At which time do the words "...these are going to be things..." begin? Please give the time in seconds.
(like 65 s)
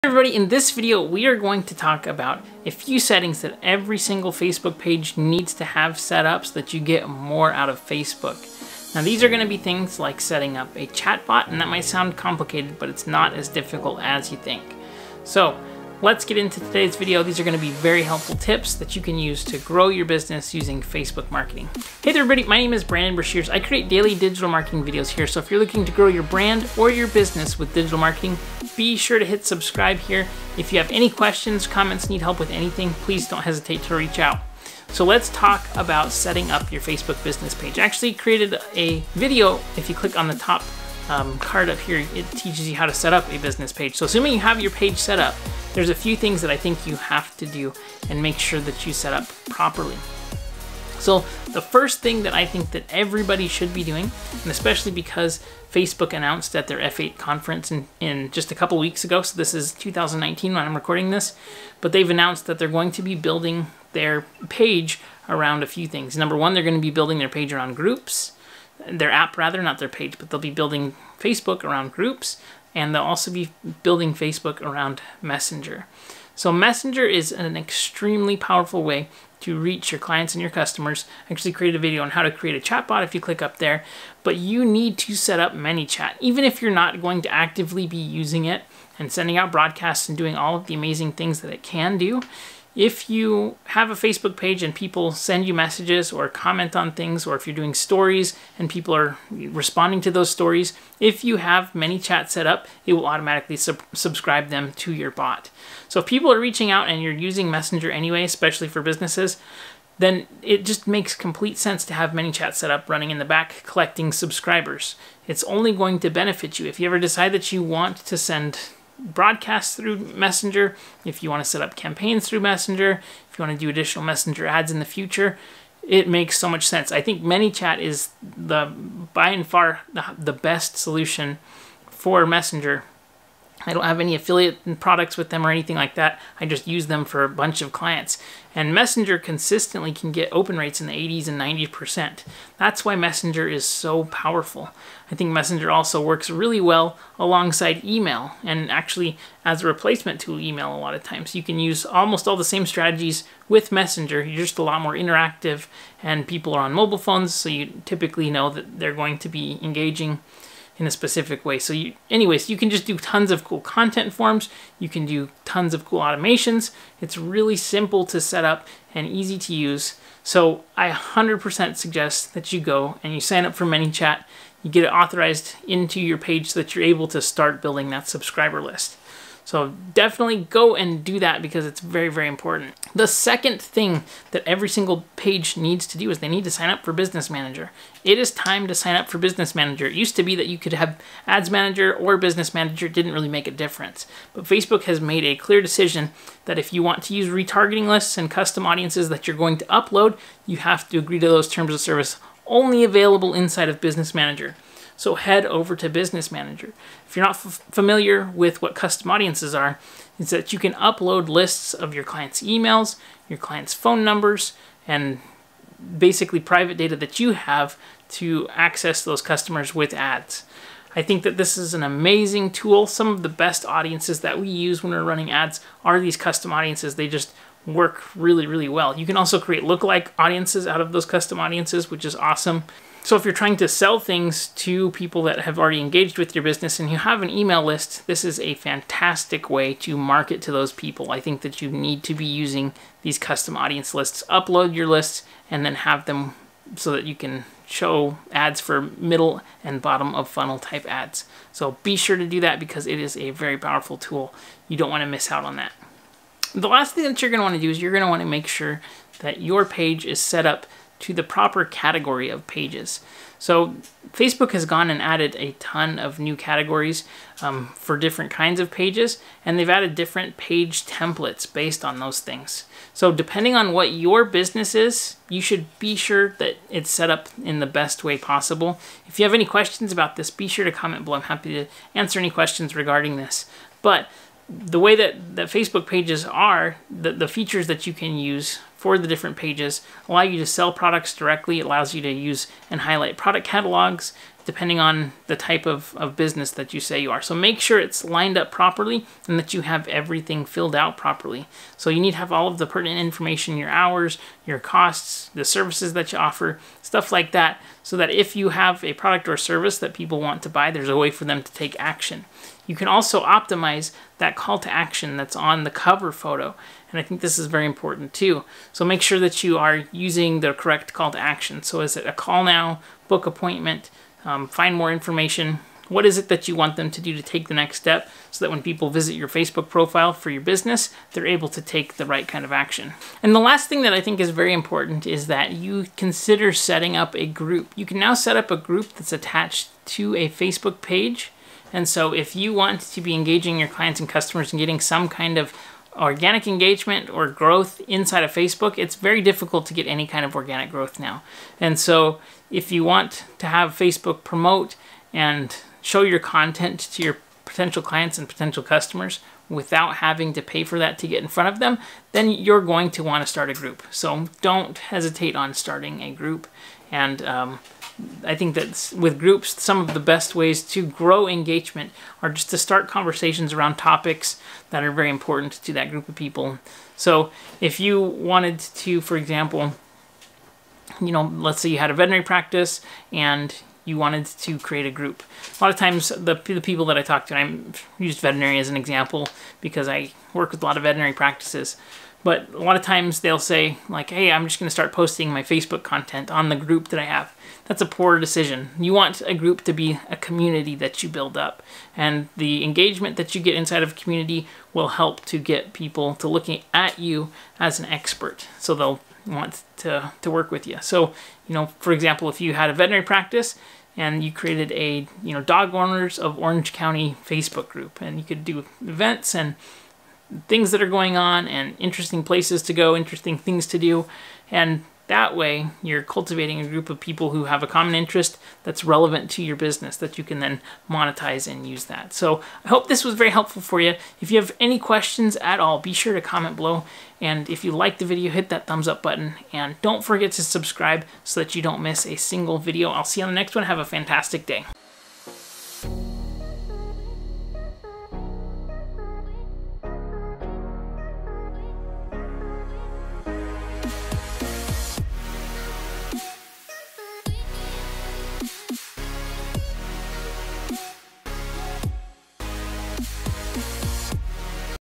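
9 s.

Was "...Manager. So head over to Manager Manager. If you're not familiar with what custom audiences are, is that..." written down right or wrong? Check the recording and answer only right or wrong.
wrong.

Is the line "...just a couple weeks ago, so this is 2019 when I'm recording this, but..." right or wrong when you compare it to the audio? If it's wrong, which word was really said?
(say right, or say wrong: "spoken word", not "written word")
right.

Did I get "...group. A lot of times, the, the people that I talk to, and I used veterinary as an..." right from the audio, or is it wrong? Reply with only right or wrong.
right.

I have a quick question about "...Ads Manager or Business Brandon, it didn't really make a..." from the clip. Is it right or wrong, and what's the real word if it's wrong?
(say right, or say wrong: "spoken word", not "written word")
wrong: "Manager", not "Brandon".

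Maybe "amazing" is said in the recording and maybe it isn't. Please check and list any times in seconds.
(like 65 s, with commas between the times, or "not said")
90 s, 221 s.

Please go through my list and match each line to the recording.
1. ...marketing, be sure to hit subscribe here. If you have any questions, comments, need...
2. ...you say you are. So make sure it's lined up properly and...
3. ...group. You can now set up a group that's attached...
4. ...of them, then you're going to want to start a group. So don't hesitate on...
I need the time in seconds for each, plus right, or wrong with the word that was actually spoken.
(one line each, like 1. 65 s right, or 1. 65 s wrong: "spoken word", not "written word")
1. 27 s right
2. 296 s right
3. 337 s right
4. 361 s right.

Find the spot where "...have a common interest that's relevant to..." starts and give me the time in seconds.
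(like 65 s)
427 s.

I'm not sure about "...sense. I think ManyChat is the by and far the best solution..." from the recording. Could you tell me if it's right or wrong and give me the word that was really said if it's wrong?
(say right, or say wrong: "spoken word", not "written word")
right.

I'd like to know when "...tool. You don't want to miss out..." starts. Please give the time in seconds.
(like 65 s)
253 s.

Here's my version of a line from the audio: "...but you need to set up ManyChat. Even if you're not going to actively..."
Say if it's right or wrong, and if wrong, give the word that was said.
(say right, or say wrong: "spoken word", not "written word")
right.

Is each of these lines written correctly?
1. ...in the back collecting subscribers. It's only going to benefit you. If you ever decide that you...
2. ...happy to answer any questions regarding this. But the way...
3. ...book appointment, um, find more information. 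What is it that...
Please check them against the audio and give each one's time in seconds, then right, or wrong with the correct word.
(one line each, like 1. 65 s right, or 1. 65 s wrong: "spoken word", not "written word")
1. 113 s right
2. 281 s right
3. 323 s right.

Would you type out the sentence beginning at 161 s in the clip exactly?
So you, anyways, you can just do tons of cool content forms.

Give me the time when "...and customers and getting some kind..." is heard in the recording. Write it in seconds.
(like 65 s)
343 s.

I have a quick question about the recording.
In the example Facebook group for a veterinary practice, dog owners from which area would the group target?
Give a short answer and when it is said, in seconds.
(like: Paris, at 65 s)
Orange County, at 416 s.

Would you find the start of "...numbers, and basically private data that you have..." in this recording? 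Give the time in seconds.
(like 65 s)
214 s.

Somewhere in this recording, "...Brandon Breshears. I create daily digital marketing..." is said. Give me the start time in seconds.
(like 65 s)
22 s.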